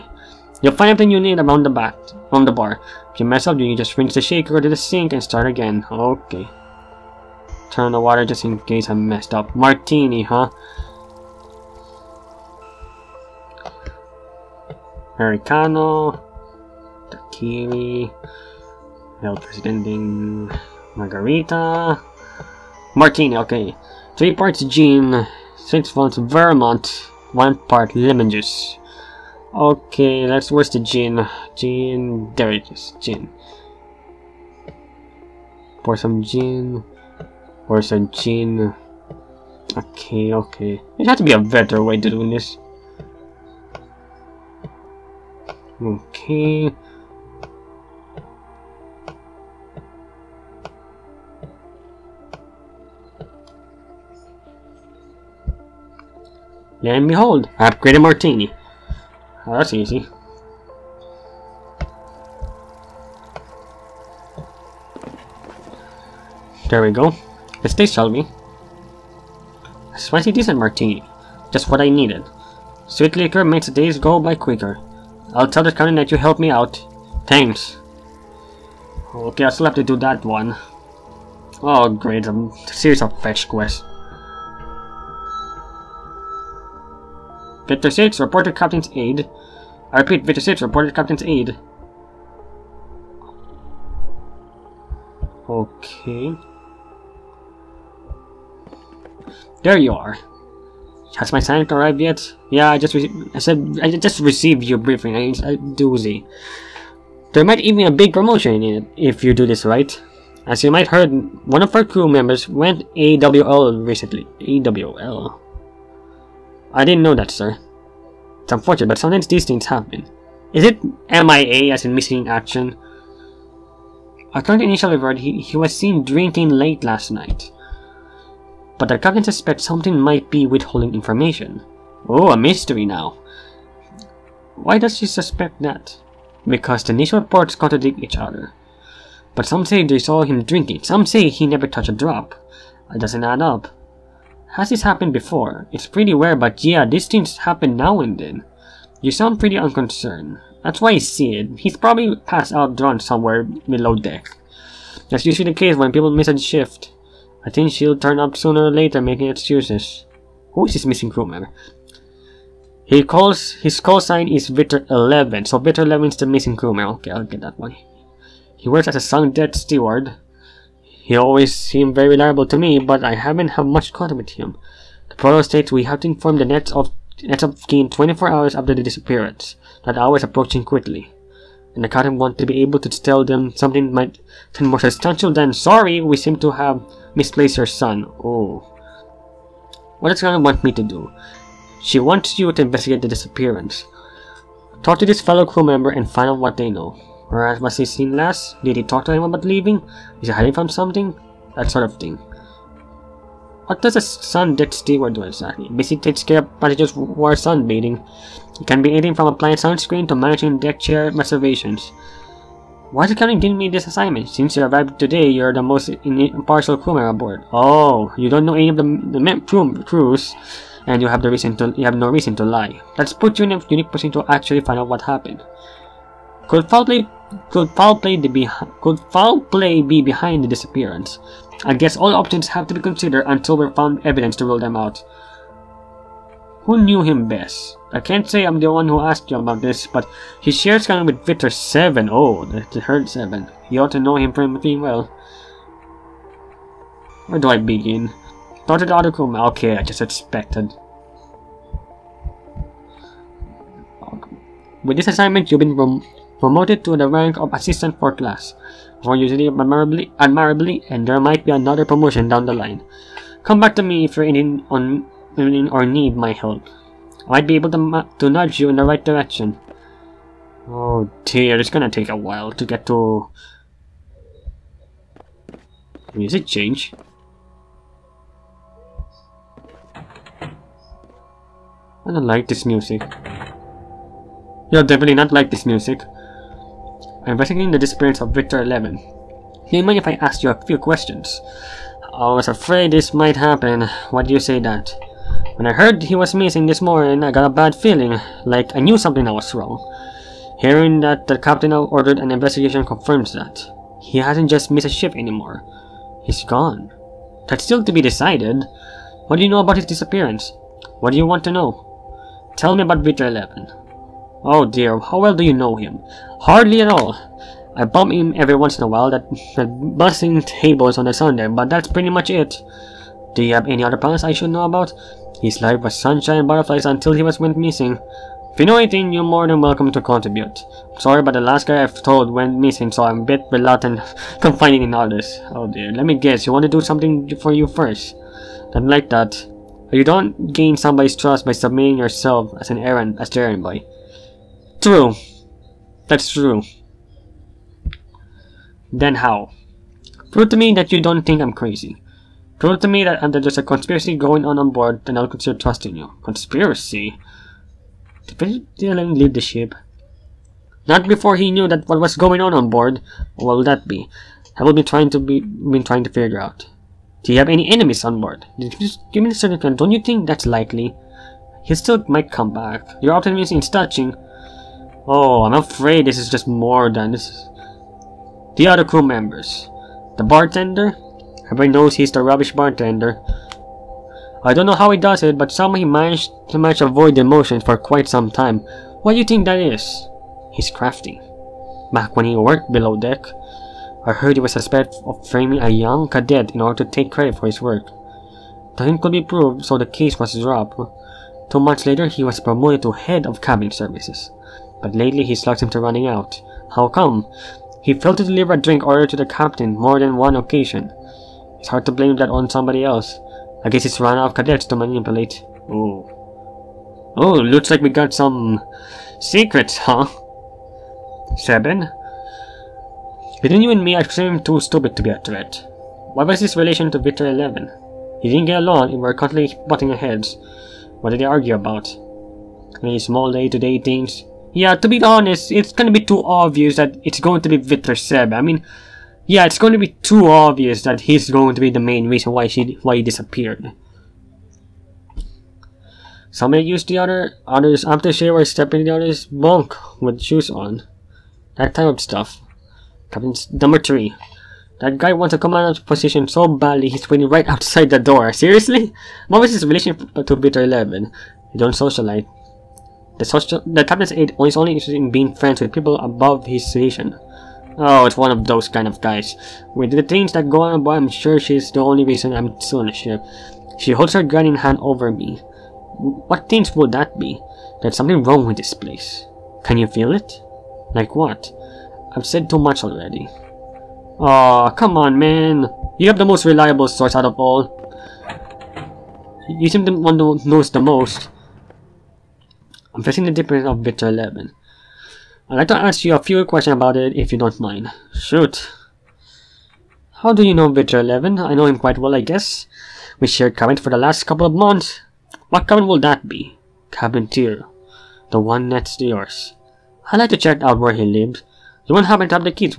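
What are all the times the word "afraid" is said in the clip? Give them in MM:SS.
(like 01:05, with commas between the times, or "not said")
04:52, 06:15.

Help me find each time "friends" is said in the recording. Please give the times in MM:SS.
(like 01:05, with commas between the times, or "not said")
07:45.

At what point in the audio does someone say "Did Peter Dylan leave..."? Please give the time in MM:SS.
05:58.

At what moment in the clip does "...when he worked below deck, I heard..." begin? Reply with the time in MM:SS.
06:32.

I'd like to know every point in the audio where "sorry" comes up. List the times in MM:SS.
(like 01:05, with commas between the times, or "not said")
03:05, 05:30.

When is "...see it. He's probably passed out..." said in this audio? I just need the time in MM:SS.
02:30.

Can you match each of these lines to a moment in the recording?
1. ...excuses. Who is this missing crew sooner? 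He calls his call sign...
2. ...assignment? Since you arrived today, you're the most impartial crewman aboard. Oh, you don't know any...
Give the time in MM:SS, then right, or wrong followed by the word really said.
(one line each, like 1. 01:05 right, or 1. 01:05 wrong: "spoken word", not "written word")
1. 02:39 wrong: "member", not "sooner"
2. 03:33 right.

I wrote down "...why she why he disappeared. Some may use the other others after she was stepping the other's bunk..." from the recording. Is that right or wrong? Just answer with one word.
right.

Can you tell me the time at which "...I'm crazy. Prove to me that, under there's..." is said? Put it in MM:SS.
05:51.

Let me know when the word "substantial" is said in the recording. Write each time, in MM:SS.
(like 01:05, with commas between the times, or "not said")
03:04.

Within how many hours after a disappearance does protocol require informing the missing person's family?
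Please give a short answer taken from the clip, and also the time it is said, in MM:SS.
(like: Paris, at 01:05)
24, at 02:57.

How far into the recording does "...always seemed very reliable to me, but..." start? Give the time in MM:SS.
02:51.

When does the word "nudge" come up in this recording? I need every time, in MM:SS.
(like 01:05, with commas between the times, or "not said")
04:28.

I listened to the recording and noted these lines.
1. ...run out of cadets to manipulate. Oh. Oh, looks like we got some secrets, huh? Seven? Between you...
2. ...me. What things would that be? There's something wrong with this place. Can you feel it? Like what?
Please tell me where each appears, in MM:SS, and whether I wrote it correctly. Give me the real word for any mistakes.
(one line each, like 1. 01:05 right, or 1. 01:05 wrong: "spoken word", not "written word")
1. 06:53 right
2. 07:55 right.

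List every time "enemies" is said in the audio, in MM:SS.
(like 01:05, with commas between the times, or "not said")
06:07.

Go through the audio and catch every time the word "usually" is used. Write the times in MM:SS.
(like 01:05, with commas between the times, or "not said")
02:35, 04:19.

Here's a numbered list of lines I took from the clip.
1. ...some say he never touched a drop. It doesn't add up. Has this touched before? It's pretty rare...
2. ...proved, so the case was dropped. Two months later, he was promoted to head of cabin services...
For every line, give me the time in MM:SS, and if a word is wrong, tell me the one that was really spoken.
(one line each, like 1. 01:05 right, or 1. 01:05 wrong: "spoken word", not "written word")
1. 02:20 wrong: "happened", not "touched"
2. 06:39 right.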